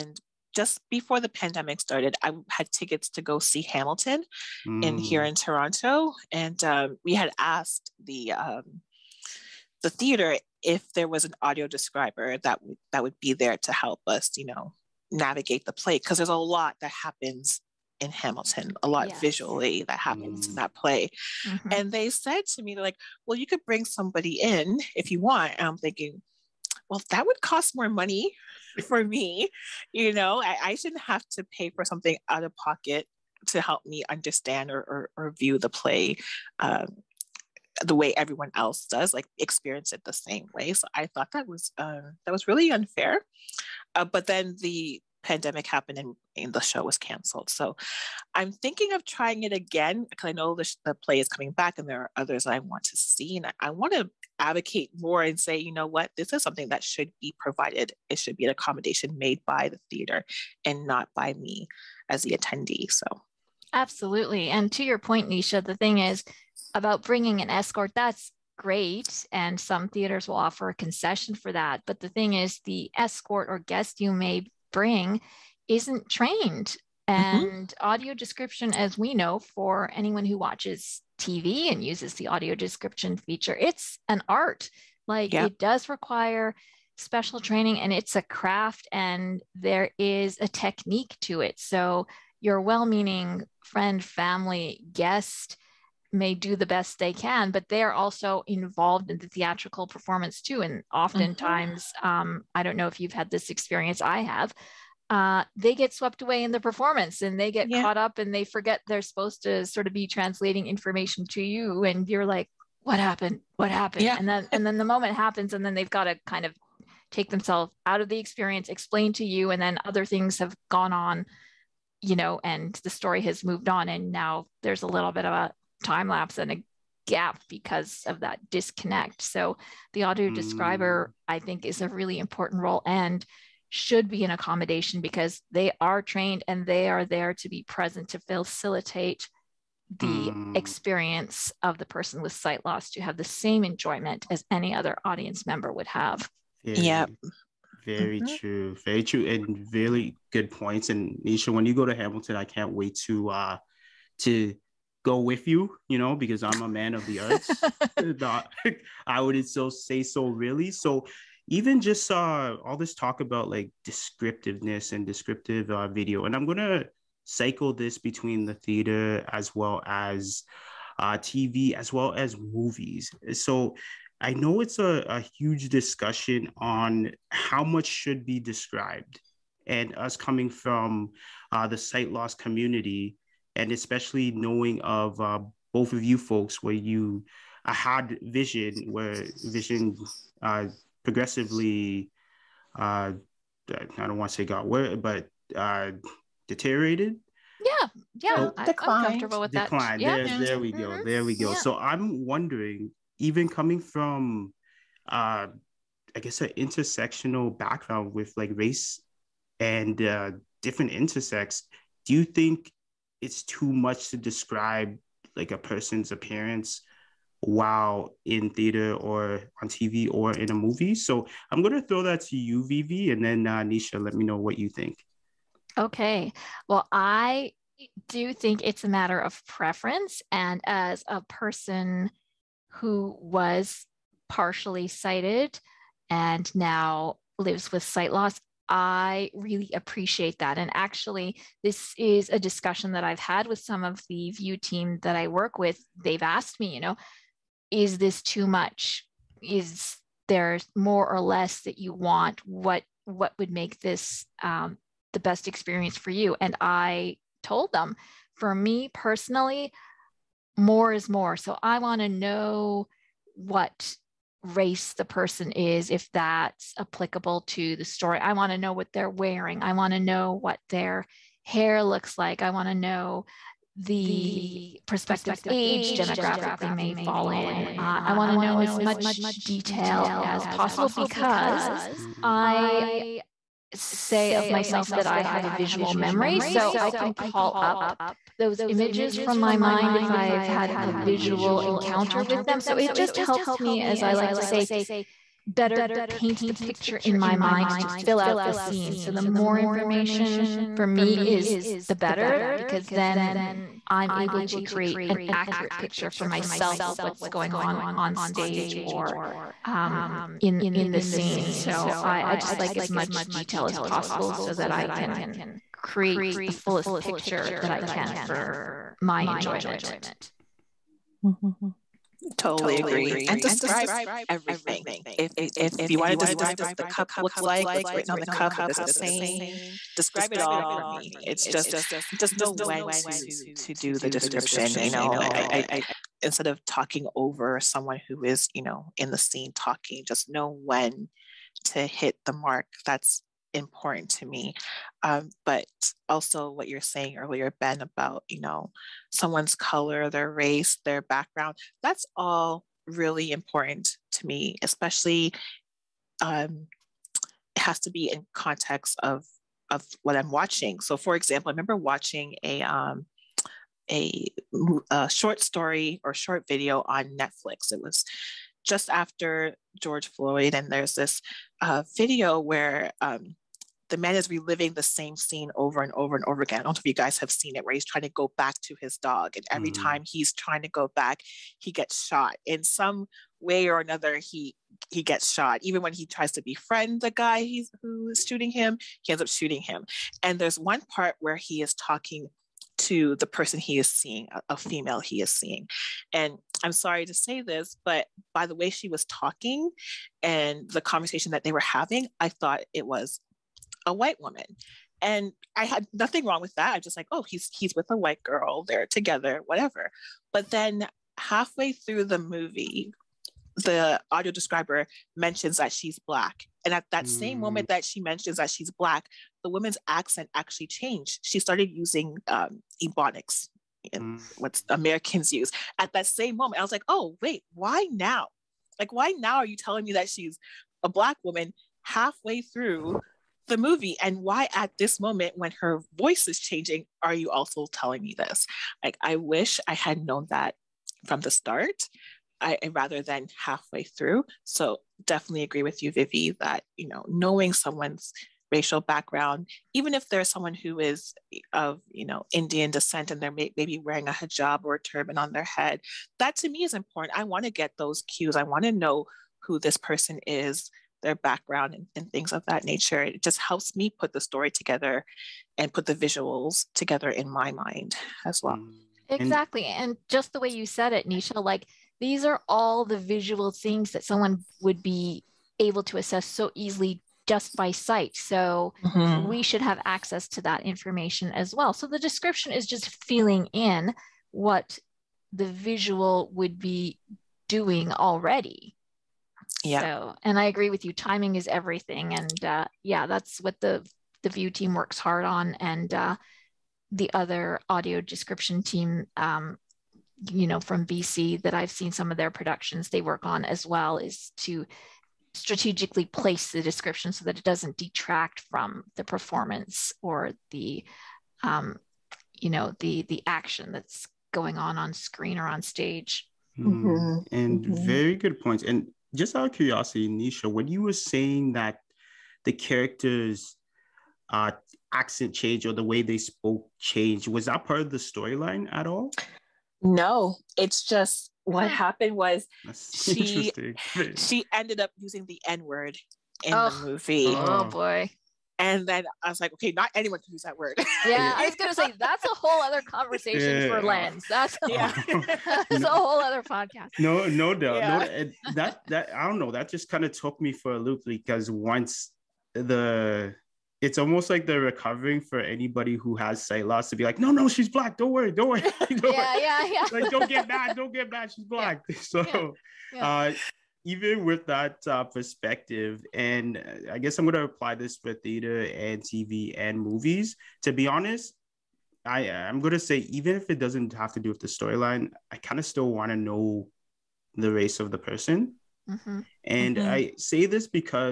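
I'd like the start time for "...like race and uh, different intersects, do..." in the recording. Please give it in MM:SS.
03:28.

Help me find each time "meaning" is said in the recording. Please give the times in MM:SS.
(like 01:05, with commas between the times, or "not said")
01:32.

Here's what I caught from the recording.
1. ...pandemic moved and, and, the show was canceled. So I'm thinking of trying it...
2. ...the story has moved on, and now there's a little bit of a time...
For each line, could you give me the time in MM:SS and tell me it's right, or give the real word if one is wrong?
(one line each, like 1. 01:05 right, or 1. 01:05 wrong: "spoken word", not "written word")
1. 00:45 wrong: "happened", not "moved"
2. 02:02 right.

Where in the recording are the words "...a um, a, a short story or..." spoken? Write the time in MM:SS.
06:02.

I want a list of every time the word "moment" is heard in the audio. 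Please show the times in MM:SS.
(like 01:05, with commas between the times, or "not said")
01:54, 06:57, 07:06, 07:14.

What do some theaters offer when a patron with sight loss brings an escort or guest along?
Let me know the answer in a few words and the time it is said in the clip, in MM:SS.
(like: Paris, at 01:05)
A concession, at 01:10.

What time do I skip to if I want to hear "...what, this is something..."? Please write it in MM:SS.
00:55.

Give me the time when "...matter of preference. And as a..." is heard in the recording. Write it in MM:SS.
03:48.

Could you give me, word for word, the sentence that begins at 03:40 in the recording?
So I'm going to throw that to you, Vivi, and then uh, Neisha, let me know what you think.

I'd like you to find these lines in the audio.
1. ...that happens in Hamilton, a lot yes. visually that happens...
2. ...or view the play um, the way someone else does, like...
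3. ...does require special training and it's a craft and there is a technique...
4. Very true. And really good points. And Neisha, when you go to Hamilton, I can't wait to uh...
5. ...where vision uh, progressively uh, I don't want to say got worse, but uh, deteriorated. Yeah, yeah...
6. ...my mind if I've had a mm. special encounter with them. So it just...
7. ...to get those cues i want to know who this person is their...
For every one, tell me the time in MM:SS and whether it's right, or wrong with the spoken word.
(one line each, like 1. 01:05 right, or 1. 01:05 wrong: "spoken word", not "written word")
1. 00:16 right
2. 00:35 wrong: "everyone", not "someone"
3. 01:25 right
4. 02:28 right
5. 03:08 right
6. 04:49 wrong: "visual", not "special"
7. 07:37 right.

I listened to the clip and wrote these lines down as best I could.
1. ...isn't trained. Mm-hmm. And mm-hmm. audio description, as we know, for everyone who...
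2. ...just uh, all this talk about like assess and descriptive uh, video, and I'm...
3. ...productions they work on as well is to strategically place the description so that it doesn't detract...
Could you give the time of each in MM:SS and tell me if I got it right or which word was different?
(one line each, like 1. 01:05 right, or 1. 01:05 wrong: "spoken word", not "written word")
1. 01:15 wrong: "anyone", not "everyone"
2. 02:41 wrong: "descriptiveness", not "assess"
3. 08:22 right.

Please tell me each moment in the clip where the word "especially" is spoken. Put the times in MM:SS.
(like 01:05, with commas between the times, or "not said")
03:03, 05:54.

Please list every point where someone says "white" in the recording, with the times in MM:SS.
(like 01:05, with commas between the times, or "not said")
06:43, 06:47.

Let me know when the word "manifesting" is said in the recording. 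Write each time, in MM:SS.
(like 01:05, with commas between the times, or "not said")
not said.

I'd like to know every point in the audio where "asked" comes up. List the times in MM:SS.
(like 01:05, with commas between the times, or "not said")
00:07, 04:06.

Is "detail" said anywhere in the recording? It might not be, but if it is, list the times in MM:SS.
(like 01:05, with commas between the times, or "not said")
04:39, 05:13.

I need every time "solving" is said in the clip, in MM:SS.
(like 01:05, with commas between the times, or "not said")
not said.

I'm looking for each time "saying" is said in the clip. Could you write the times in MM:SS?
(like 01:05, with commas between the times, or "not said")
05:28, 05:46, 08:40.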